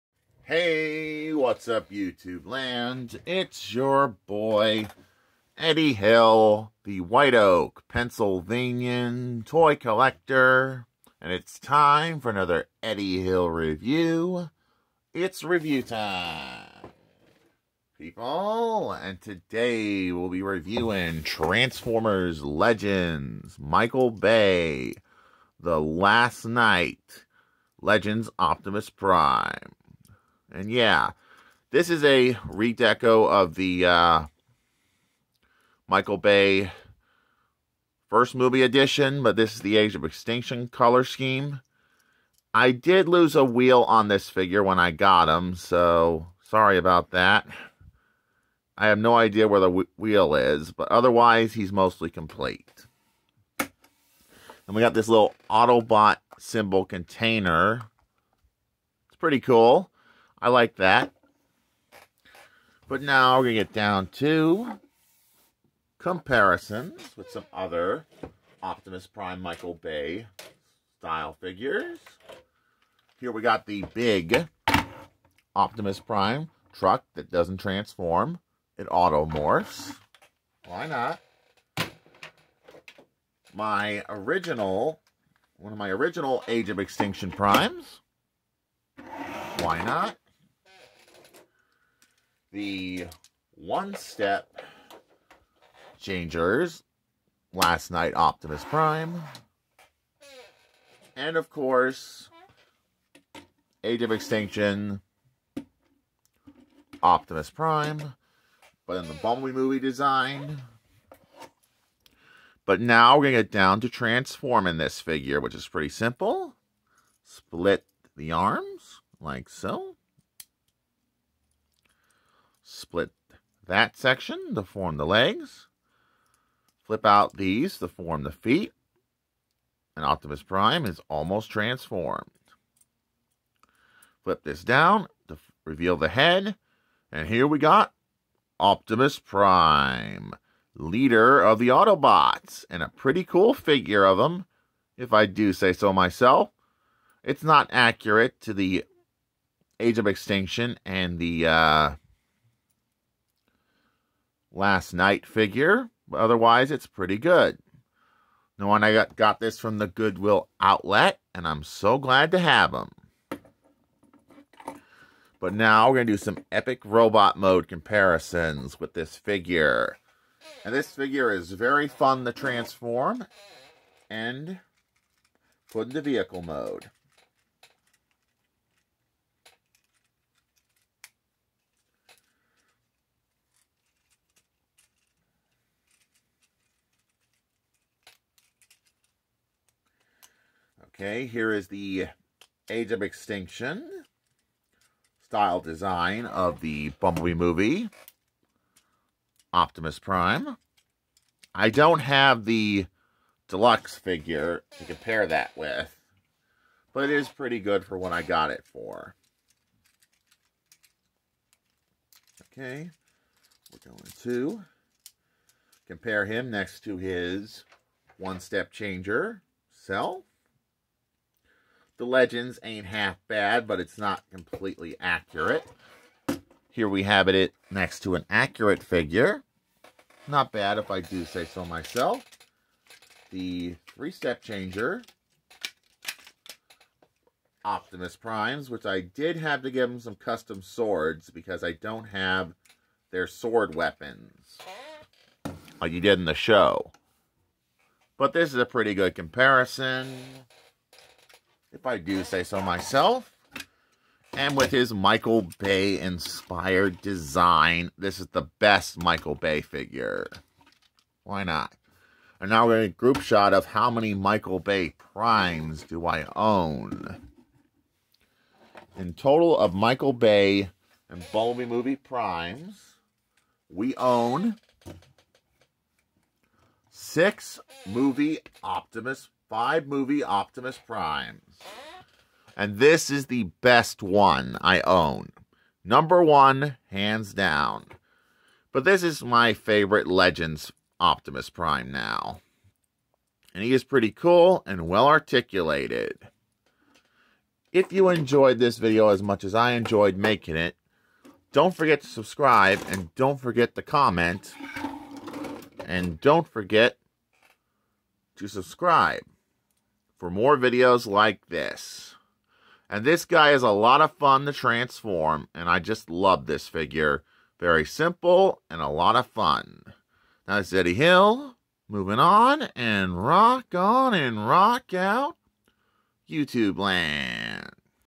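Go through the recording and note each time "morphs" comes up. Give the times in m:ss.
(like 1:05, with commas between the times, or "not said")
1:18.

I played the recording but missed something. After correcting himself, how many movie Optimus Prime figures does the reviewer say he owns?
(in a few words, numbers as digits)
5.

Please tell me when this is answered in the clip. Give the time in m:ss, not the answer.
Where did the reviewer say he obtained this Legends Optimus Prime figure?
2:39.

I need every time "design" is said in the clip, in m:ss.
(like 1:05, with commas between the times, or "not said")
1:49, 3:15, 4:17.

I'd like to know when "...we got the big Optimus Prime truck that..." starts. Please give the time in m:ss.
1:13.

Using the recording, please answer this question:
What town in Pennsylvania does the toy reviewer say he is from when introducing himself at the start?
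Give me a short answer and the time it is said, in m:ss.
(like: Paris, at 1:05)
White Oak, at 0:06.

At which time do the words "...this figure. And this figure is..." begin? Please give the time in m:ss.
2:48.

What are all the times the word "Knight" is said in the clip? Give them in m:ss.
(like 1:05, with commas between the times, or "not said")
0:26, 1:37, 2:34.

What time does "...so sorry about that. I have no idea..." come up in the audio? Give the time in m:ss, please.
0:45.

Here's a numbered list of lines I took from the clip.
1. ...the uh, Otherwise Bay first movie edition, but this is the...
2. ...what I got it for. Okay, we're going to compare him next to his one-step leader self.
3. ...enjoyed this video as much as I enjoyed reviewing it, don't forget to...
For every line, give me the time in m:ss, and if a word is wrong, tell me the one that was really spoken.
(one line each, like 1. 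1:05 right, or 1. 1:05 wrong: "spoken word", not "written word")
1. 0:33 wrong: "Michael", not "Otherwise"
2. 3:27 wrong: "changer", not "leader"
3. 4:58 wrong: "making", not "reviewing".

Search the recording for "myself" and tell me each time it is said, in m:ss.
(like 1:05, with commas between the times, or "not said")
2:25, 3:51, 4:12.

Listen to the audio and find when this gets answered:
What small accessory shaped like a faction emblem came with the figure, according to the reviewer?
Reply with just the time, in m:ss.
0:55.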